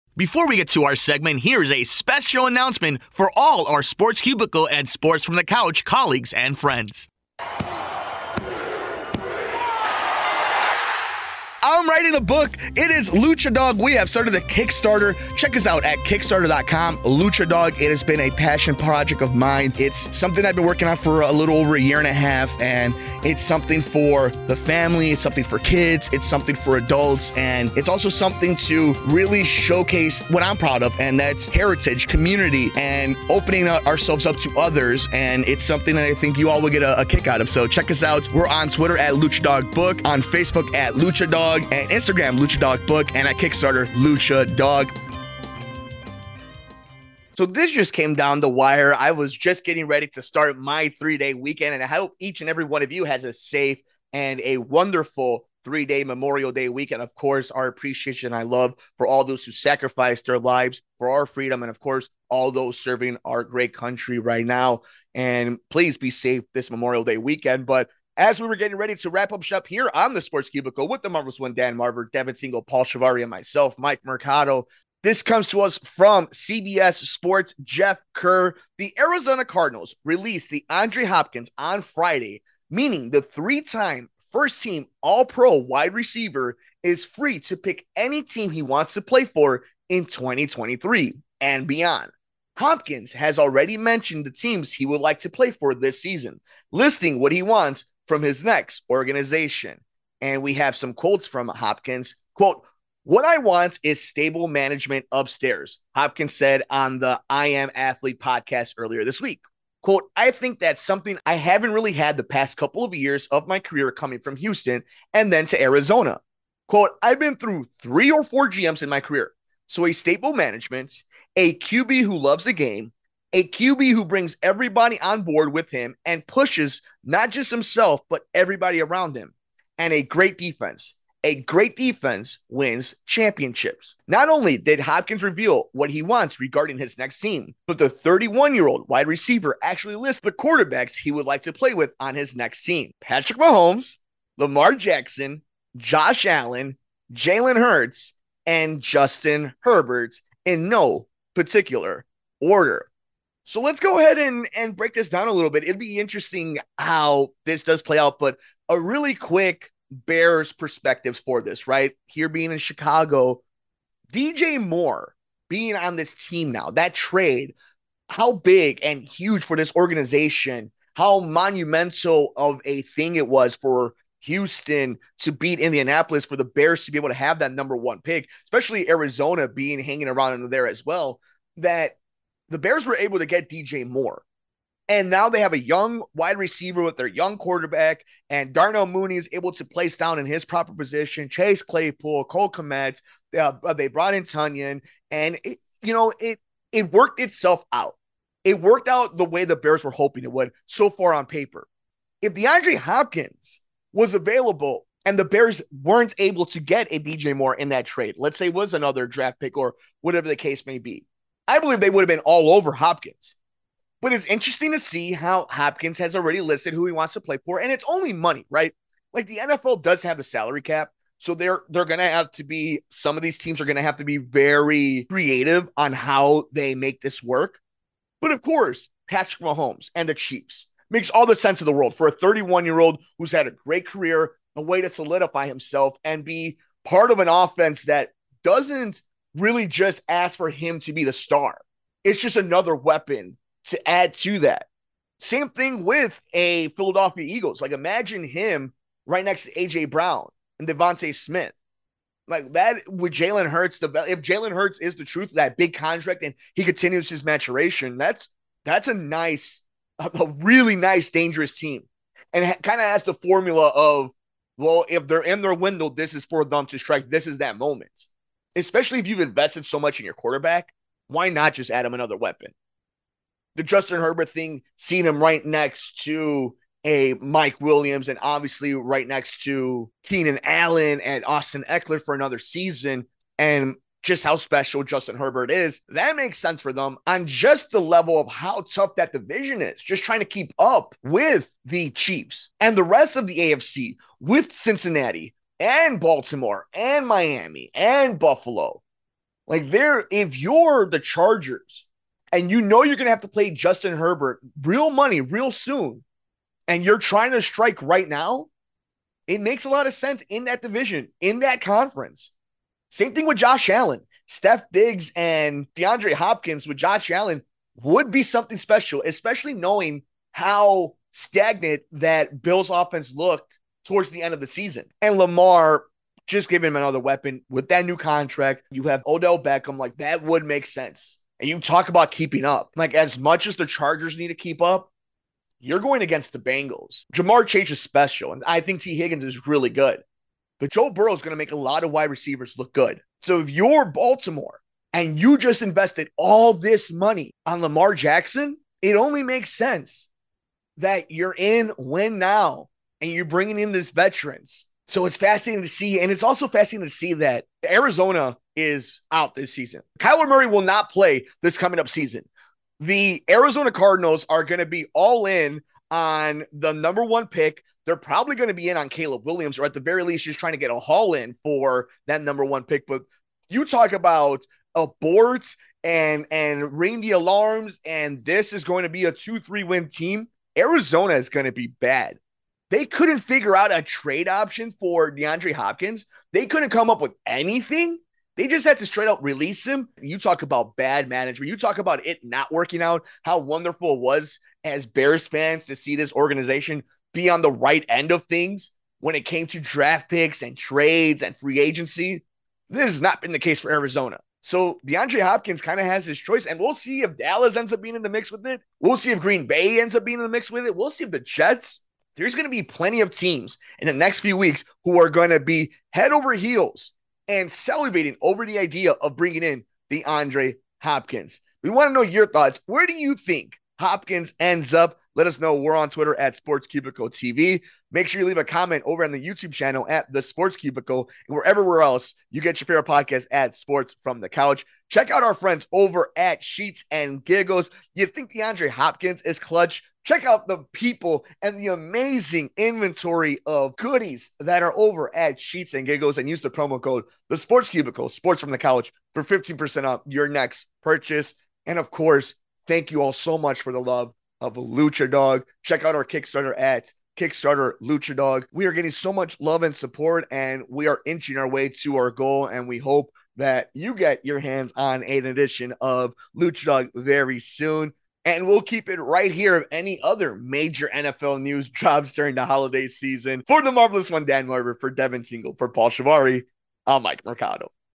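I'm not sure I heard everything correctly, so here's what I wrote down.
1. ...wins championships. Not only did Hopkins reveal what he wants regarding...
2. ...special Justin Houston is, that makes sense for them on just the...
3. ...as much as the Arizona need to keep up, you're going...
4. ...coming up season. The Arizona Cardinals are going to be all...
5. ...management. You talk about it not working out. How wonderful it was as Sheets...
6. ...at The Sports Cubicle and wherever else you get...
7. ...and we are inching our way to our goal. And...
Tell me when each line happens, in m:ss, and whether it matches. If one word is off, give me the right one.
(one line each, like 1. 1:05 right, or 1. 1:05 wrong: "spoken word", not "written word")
1. 2:12 right
2. 4:44 wrong: "Herbert", not "Houston"
3. 5:32 wrong: "Chargers", not "Arizona"
4. 6:01 right
5. 6:31 wrong: "Bears", not "Sheets"
6. 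7:09 right
7. 7:40 right.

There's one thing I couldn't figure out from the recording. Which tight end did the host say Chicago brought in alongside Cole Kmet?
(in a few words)
Tonyan.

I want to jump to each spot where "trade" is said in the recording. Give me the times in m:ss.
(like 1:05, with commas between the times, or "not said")
2:46, 3:27, 6:23, 6:40.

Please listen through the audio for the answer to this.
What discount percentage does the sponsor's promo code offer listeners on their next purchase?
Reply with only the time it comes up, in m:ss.
7:29.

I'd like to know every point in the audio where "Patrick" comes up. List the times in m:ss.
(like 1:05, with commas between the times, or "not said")
2:23, 3:49.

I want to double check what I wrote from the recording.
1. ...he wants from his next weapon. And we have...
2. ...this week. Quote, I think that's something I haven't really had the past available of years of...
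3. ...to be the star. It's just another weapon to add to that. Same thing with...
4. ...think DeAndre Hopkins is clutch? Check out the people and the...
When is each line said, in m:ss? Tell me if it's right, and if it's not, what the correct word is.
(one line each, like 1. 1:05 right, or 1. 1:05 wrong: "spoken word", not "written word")
1. 1:37 wrong: "organization", not "weapon"
2. 1:49 wrong: "couple", not "available"
3. 4:00 right
4. 7:18 right.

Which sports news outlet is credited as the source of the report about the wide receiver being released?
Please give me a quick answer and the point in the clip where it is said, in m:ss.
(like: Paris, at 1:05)
CBS Sports, at 1:16.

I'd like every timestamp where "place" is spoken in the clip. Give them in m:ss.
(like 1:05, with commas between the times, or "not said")
3:09.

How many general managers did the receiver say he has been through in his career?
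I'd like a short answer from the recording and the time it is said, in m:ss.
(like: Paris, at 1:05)
3 or 4, at 1:57.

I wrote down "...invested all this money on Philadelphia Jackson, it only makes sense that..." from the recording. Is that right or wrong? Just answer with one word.
wrong.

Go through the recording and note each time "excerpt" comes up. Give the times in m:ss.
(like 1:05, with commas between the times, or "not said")
not said.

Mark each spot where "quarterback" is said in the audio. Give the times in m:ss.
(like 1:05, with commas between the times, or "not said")
2:20, 3:07, 4:30.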